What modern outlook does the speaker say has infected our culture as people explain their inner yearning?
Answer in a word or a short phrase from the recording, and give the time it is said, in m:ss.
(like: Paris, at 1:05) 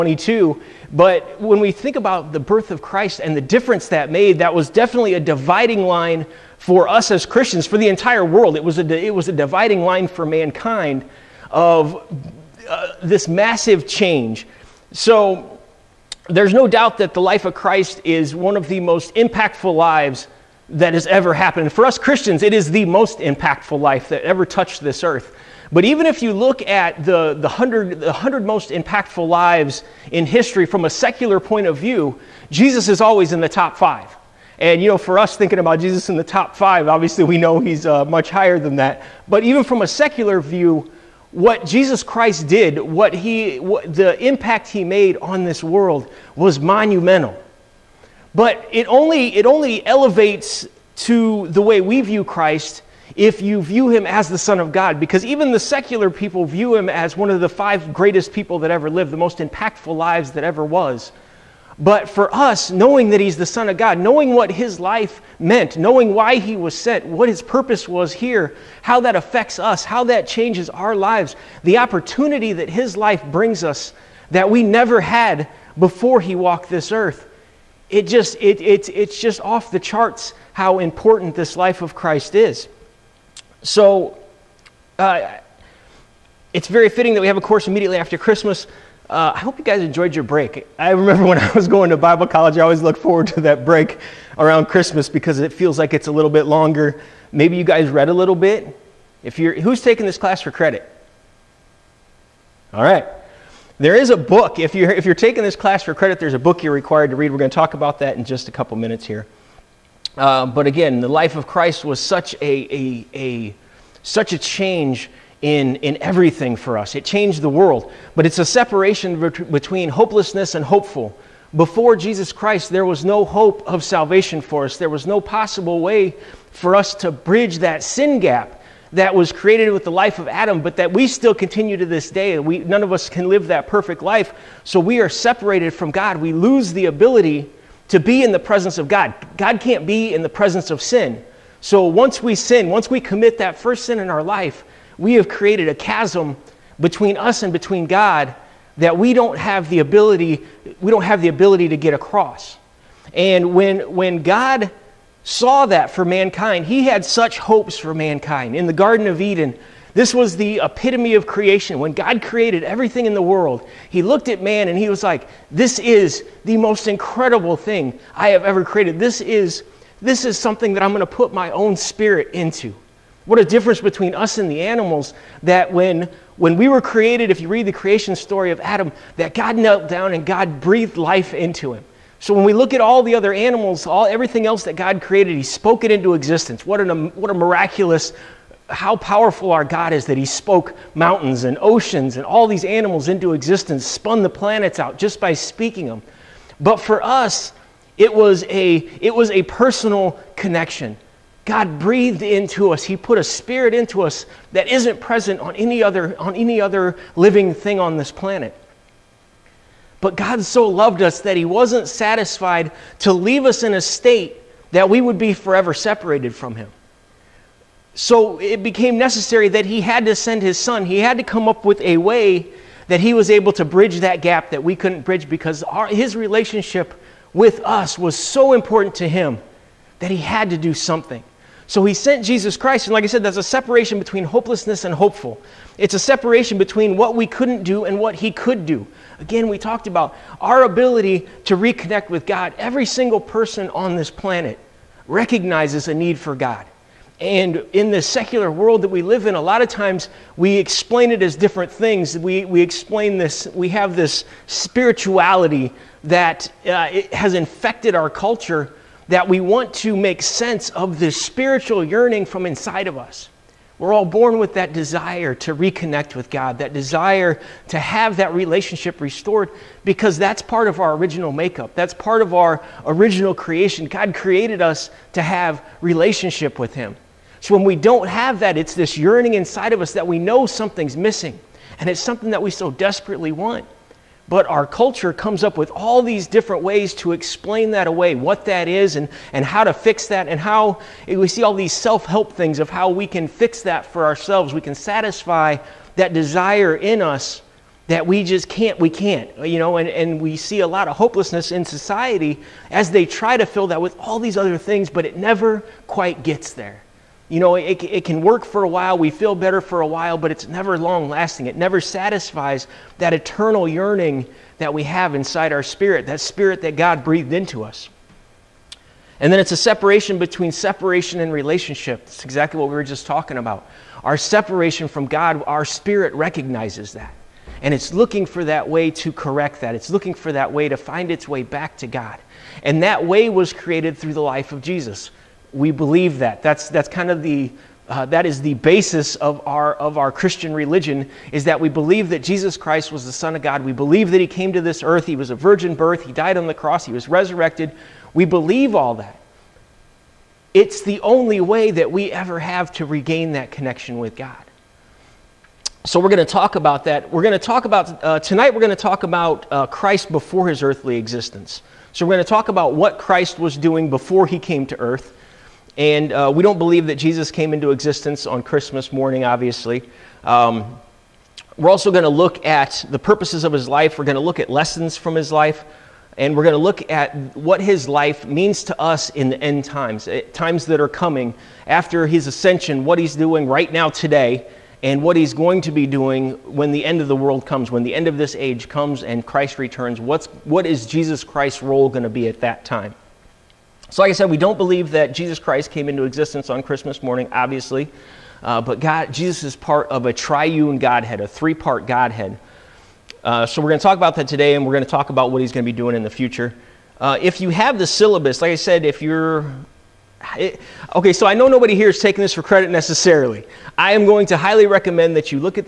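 spirituality, at 4:14.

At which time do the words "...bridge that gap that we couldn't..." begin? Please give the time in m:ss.
3:43.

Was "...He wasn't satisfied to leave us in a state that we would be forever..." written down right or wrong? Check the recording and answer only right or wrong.
right.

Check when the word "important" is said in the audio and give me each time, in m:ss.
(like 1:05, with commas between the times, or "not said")
1:20, 3:48.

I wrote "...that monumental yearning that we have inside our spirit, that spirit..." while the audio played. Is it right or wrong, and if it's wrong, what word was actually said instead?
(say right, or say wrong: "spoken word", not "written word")
wrong: "eternal", not "monumental".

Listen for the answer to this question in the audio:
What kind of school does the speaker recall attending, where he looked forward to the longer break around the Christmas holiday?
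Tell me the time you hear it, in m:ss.
1:31.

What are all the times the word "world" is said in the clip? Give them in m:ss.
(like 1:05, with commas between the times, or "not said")
0:08, 0:45, 1:57, 2:43, 4:08, 6:27.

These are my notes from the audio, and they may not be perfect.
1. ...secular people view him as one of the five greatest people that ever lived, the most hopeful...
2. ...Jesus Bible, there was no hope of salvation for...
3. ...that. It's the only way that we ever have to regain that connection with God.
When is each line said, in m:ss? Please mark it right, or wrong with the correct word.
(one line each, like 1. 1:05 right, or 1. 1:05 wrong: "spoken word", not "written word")
1. 0:55 wrong: "impactful", not "hopeful"
2. 2:01 wrong: "Christ", not "Bible"
3. 5:48 right.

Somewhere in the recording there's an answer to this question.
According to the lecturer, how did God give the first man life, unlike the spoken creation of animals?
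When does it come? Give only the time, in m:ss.
3:00.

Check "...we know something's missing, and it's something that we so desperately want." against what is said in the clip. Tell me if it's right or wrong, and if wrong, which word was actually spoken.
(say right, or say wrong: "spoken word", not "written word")
right.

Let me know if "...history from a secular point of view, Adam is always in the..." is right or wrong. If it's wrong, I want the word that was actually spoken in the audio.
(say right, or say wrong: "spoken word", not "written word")
wrong: "Jesus", not "Adam".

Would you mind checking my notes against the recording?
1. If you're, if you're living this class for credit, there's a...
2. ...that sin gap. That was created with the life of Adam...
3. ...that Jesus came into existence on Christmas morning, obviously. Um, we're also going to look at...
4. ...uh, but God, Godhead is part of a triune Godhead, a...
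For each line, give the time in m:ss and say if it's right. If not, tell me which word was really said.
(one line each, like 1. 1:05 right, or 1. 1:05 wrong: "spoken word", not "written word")
1. 1:44 wrong: "taking", not "living"
2. 2:07 right
3. 6:06 right
4. 6:38 wrong: "Jesus", not "Godhead".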